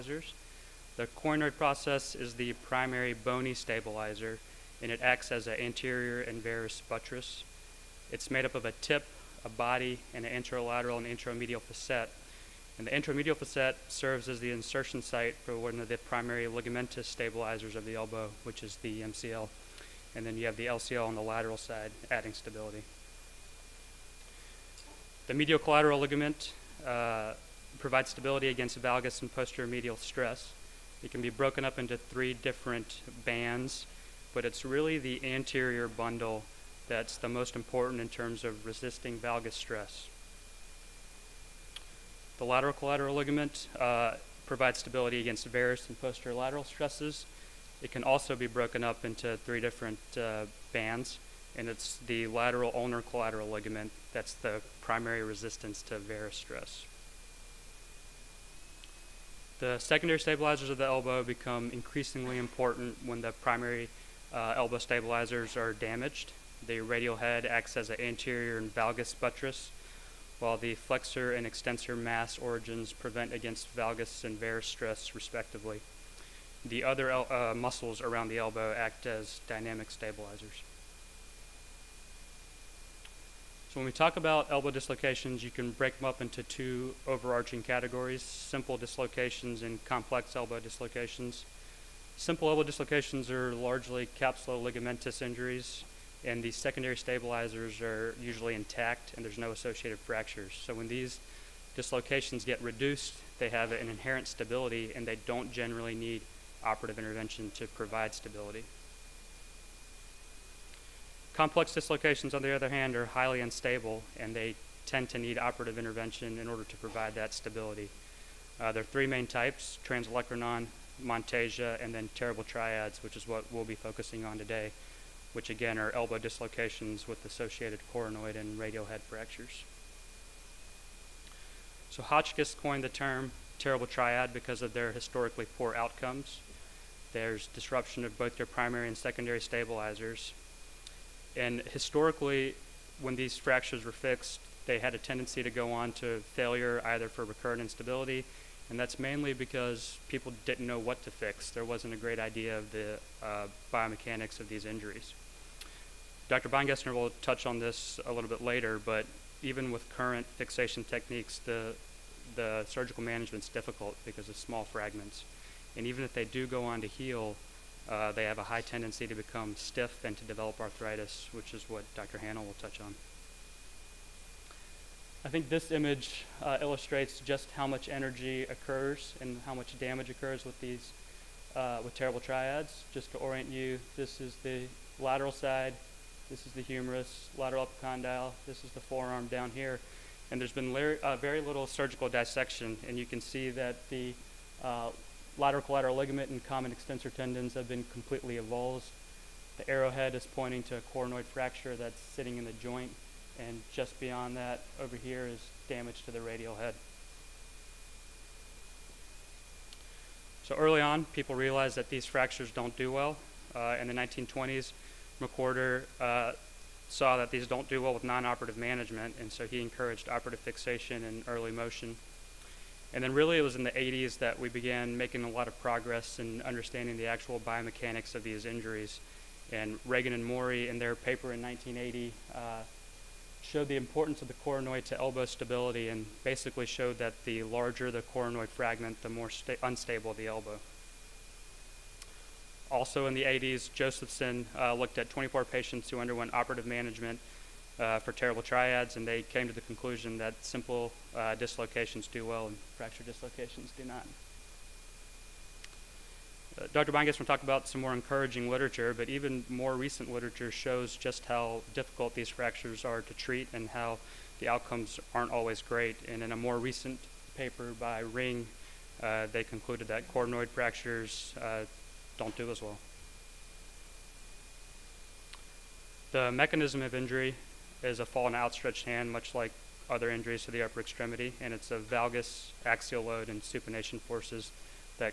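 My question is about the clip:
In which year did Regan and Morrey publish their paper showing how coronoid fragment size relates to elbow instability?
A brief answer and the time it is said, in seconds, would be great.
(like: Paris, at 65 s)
1980, at 231 s.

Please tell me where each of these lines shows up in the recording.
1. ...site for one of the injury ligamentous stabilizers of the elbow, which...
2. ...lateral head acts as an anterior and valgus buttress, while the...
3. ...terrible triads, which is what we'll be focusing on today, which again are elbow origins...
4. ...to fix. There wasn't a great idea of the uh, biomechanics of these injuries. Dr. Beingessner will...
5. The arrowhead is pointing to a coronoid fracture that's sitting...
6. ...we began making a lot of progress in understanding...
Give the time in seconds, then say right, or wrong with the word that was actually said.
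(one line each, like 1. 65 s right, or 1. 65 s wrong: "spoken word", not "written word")
1. 15 s wrong: "primary", not "injury"
2. 66 s wrong: "radial", not "lateral"
3. 122 s wrong: "dislocations", not "origins"
4. 151 s right
5. 199 s right
6. 224 s right.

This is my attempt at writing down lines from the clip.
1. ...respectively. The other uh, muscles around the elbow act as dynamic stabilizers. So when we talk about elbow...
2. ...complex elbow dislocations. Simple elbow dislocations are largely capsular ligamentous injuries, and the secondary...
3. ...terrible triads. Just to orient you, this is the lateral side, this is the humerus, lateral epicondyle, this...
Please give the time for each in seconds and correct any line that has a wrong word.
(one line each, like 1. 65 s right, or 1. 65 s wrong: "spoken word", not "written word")
1. 75 s right
2. 89 s right
3. 181 s right.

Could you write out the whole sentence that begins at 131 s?
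So Hotchkiss coined the term terrible triad because of their historically poor outcomes.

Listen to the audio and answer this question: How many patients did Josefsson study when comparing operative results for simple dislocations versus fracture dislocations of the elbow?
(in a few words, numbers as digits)
24.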